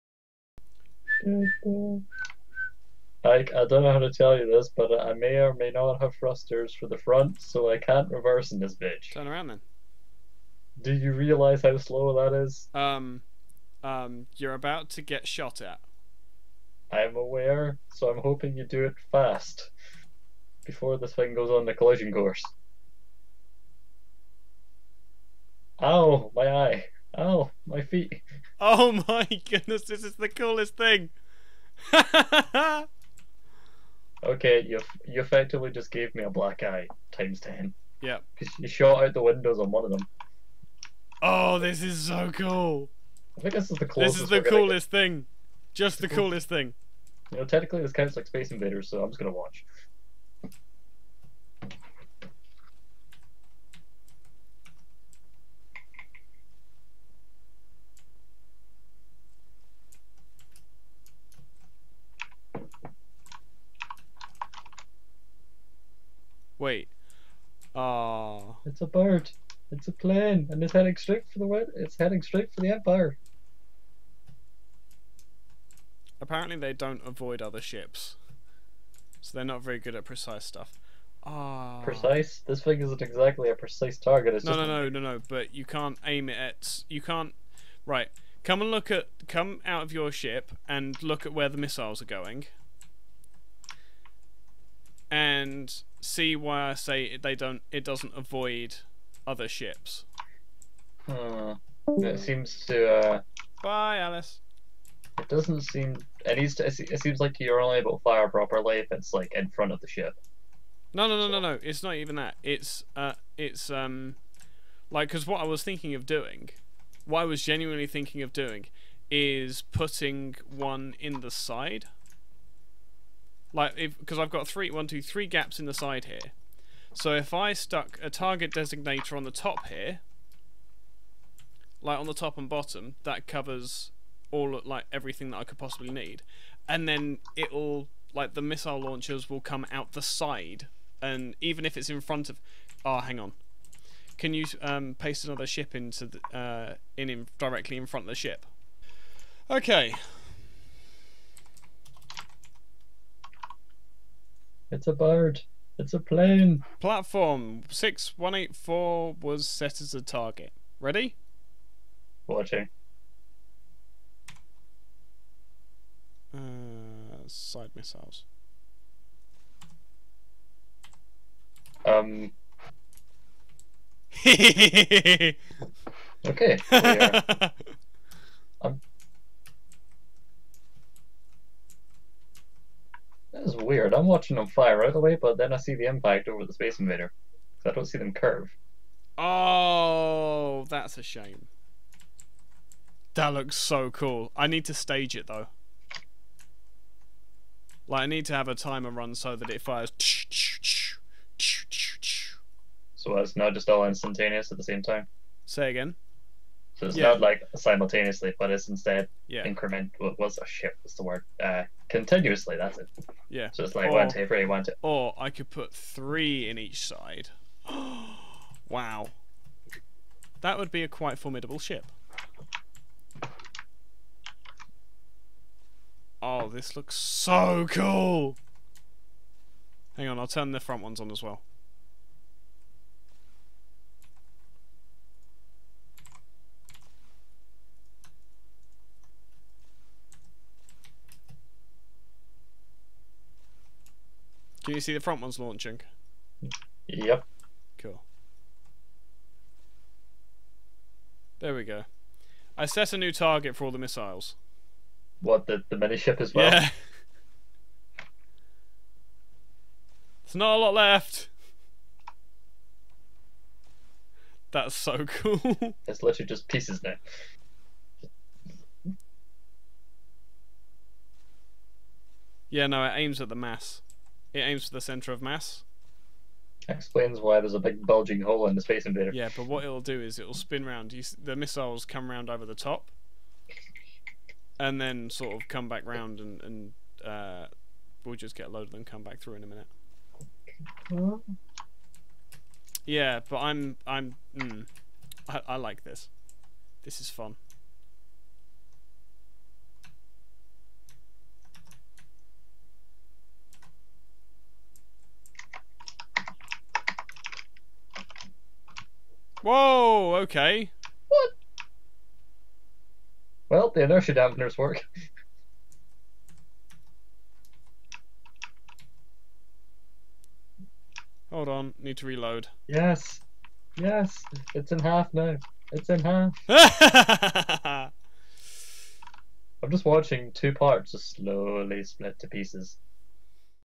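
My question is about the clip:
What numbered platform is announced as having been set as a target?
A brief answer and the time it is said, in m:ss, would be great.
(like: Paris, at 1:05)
6184, at 2:37.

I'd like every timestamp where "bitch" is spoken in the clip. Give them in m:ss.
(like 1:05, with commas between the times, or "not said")
0:08.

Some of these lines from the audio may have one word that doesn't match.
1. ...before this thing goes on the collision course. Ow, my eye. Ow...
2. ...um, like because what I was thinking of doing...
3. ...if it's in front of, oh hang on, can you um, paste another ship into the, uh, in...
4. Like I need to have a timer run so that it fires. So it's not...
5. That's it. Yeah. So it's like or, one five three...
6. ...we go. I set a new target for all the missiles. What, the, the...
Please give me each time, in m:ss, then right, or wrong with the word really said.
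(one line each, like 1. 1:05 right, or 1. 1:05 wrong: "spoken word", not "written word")
1. 0:20 right
2. 1:53 right
3. 2:21 right
4. 3:17 right
5. 3:32 wrong: "two", not "five"
6. 4:11 right.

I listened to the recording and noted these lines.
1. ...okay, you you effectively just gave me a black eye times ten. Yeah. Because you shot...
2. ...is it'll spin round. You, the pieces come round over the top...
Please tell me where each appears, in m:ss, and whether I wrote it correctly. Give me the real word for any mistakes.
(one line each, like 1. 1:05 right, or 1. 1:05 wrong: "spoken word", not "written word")
1. 0:34 right
2. 4:40 wrong: "missiles", not "pieces".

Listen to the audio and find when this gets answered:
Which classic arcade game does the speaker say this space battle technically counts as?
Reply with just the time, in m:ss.
0:48.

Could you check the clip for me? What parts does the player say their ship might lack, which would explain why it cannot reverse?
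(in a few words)
Thrusters for the front.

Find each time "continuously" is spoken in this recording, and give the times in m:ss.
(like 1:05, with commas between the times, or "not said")
3:31.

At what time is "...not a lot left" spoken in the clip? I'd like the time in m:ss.
4:20.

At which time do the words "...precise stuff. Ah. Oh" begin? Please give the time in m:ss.
1:20.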